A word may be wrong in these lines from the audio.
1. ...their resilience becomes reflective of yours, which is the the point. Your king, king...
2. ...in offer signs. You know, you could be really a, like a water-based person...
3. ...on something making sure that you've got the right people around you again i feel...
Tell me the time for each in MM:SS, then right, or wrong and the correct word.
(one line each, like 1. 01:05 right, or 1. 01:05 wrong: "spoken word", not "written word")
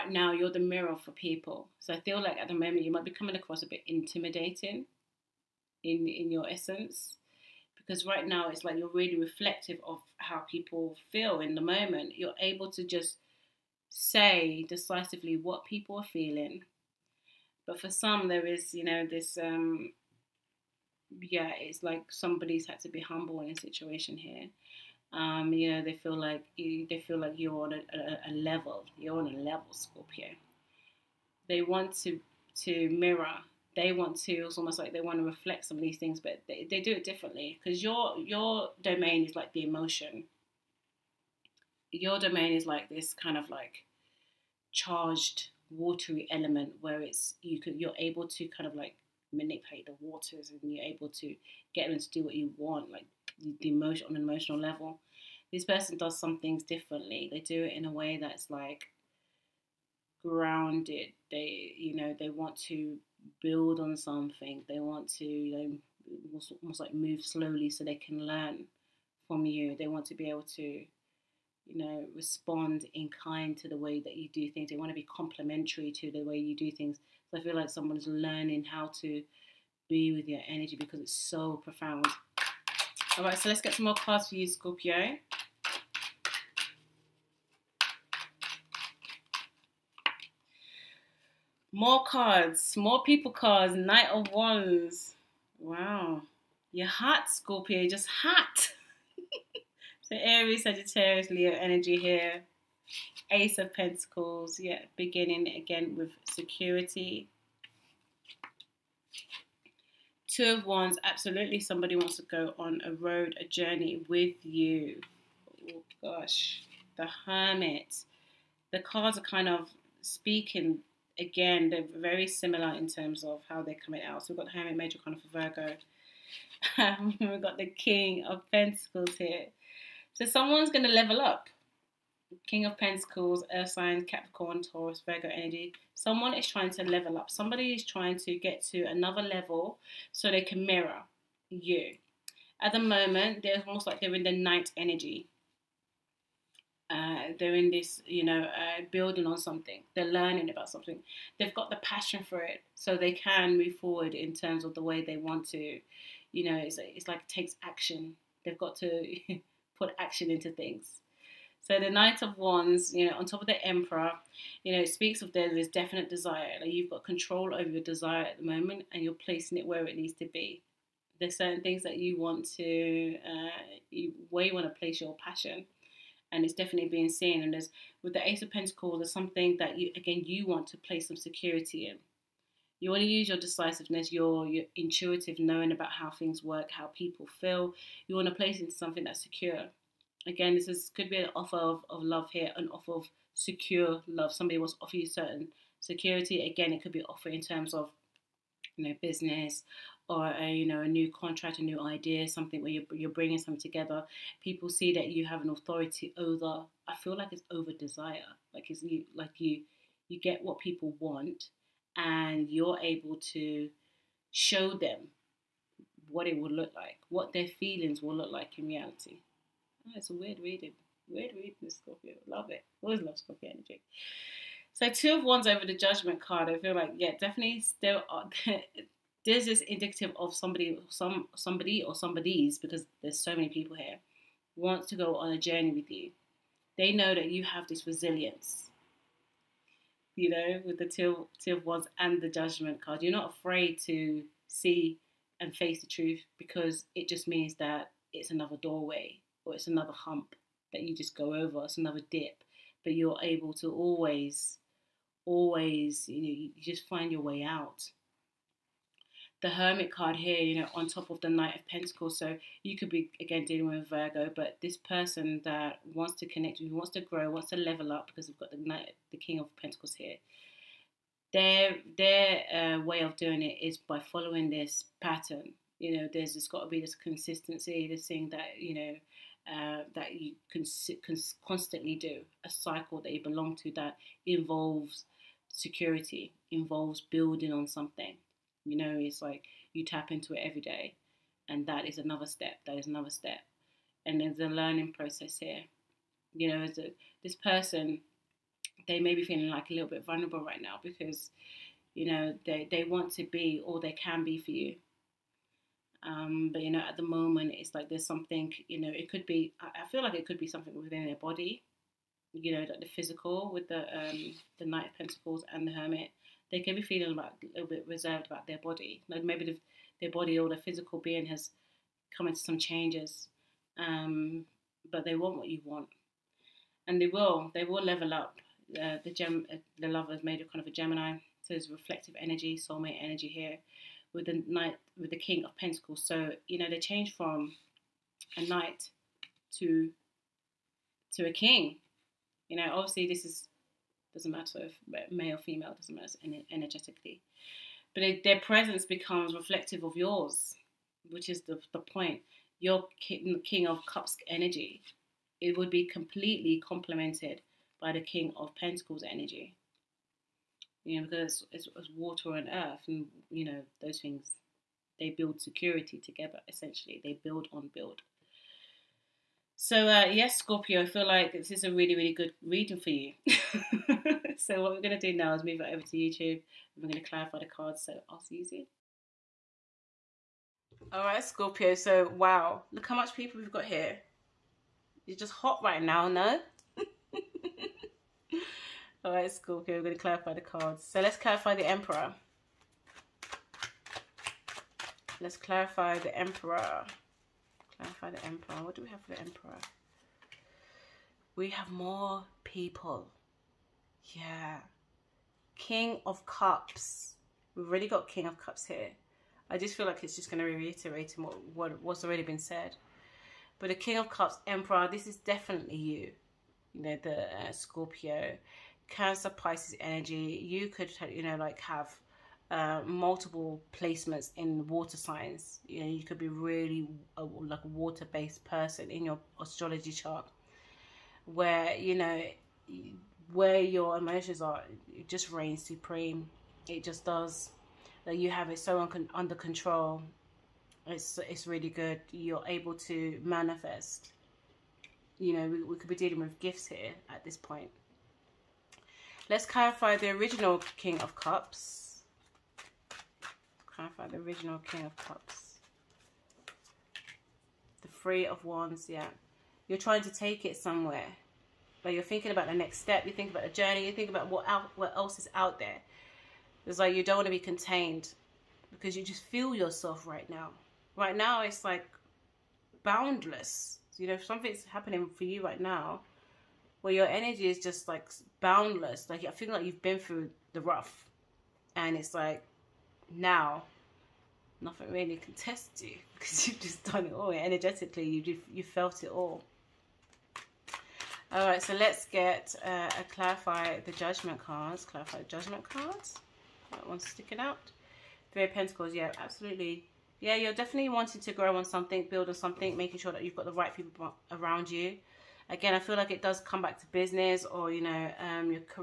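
1. 05:48 wrong: "presence", not "resilience"
2. 07:04 wrong: "water", not "offer"
3. 08:22 right.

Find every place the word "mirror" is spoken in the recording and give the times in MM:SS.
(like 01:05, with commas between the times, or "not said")
00:00, 00:32, 02:20.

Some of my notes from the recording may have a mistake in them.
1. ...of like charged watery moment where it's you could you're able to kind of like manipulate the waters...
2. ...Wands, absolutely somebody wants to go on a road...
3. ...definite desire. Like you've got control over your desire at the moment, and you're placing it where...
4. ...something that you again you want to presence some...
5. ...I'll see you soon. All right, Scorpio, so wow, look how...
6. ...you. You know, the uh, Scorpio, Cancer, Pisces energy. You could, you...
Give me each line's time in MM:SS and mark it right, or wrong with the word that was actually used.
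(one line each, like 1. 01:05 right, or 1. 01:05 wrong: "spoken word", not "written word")
1. 00:43 wrong: "element", not "moment"
2. 01:50 right
3. 02:45 right
4. 02:59 wrong: "place", not "presence"
5. 06:18 right
6. 06:55 right.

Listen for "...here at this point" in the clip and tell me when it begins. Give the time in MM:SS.
07:26.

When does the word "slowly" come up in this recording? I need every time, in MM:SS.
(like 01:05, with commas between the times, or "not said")
01:07.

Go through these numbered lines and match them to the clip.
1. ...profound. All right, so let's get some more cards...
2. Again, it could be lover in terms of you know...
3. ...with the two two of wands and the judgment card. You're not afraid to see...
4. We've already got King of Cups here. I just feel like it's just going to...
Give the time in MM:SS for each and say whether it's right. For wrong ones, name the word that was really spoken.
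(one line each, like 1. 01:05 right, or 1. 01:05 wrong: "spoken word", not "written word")
1. 01:21 right
2. 03:16 wrong: "offer", not "lover"
3. 04:00 right
4. 06:47 right.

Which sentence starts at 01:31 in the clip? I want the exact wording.
More cards, more people cards, Knight of Wands.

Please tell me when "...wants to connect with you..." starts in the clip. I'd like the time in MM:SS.
04:25.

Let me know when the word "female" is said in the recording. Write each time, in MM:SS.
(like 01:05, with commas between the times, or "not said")
05:45.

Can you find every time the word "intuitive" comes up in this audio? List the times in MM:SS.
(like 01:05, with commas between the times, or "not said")
03:04.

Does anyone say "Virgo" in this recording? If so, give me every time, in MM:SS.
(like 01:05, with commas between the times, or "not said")
02:05, 02:15, 04:23.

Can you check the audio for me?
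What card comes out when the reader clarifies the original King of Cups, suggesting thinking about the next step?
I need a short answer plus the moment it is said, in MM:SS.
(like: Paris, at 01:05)
Three of Wands, at 07:37.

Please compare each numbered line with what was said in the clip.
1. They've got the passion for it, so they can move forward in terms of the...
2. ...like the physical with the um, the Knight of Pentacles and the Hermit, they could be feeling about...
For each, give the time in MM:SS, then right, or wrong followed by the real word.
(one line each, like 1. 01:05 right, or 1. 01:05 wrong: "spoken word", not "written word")
1. 02:31 right
2. 05:12 right.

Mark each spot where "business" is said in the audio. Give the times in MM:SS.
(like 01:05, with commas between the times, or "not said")
03:19, 08:26.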